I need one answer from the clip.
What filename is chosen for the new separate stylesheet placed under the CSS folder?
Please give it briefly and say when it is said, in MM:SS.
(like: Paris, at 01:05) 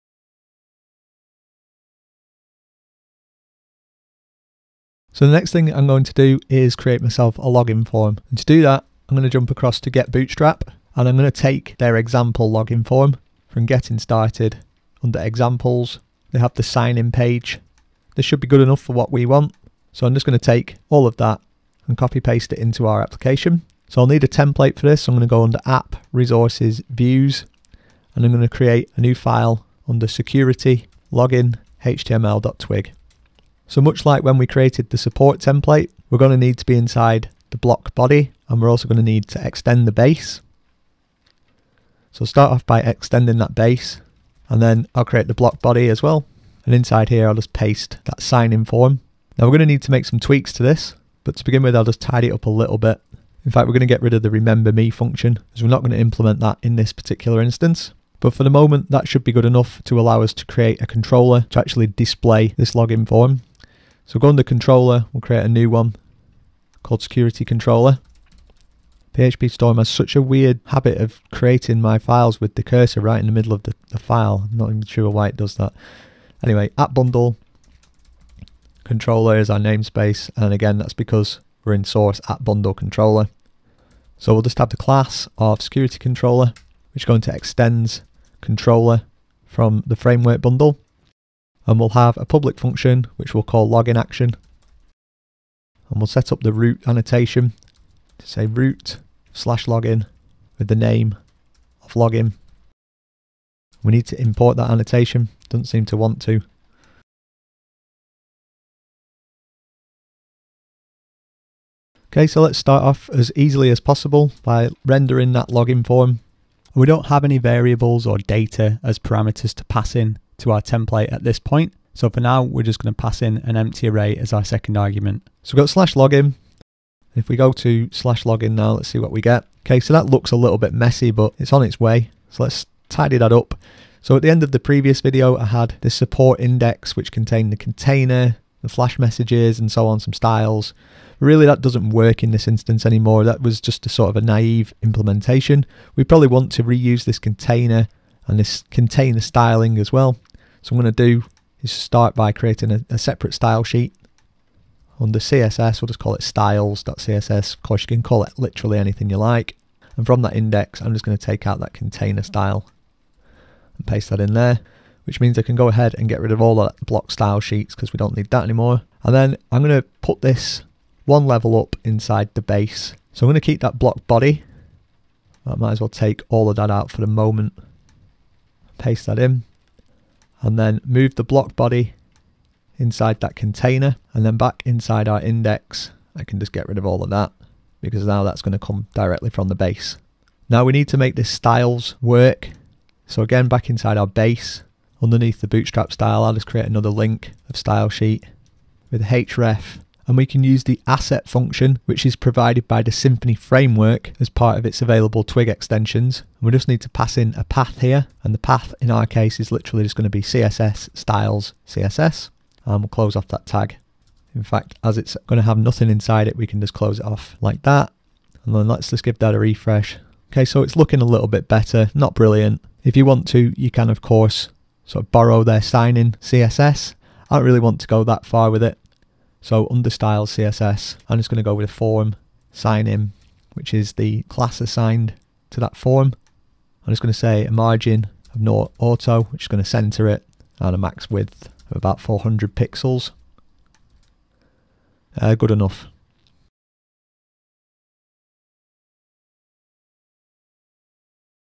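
styles.css, at 02:36.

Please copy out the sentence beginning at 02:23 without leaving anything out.
That was just a sort of a naive implementation.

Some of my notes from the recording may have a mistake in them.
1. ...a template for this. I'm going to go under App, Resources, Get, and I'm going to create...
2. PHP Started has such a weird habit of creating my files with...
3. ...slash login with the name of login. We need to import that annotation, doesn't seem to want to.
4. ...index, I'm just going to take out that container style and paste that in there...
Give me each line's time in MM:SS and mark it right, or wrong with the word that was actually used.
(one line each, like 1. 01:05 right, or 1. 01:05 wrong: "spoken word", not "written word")
1. 00:24 wrong: "Views", not "Get"
2. 01:09 wrong: "Storm", not "Started"
3. 01:39 right
4. 02:40 right.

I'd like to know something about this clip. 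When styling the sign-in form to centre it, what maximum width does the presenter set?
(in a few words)
400 pixels.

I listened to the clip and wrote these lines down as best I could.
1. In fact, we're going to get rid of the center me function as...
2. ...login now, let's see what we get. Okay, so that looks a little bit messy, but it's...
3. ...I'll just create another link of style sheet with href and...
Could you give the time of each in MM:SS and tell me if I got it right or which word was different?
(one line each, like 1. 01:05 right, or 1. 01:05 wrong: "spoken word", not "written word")
1. 00:53 wrong: "remember", not "center"
2. 02:08 right
3. 03:16 right.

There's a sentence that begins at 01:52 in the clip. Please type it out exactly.
Okay, so let's start off as easily as possible by rendering that login form.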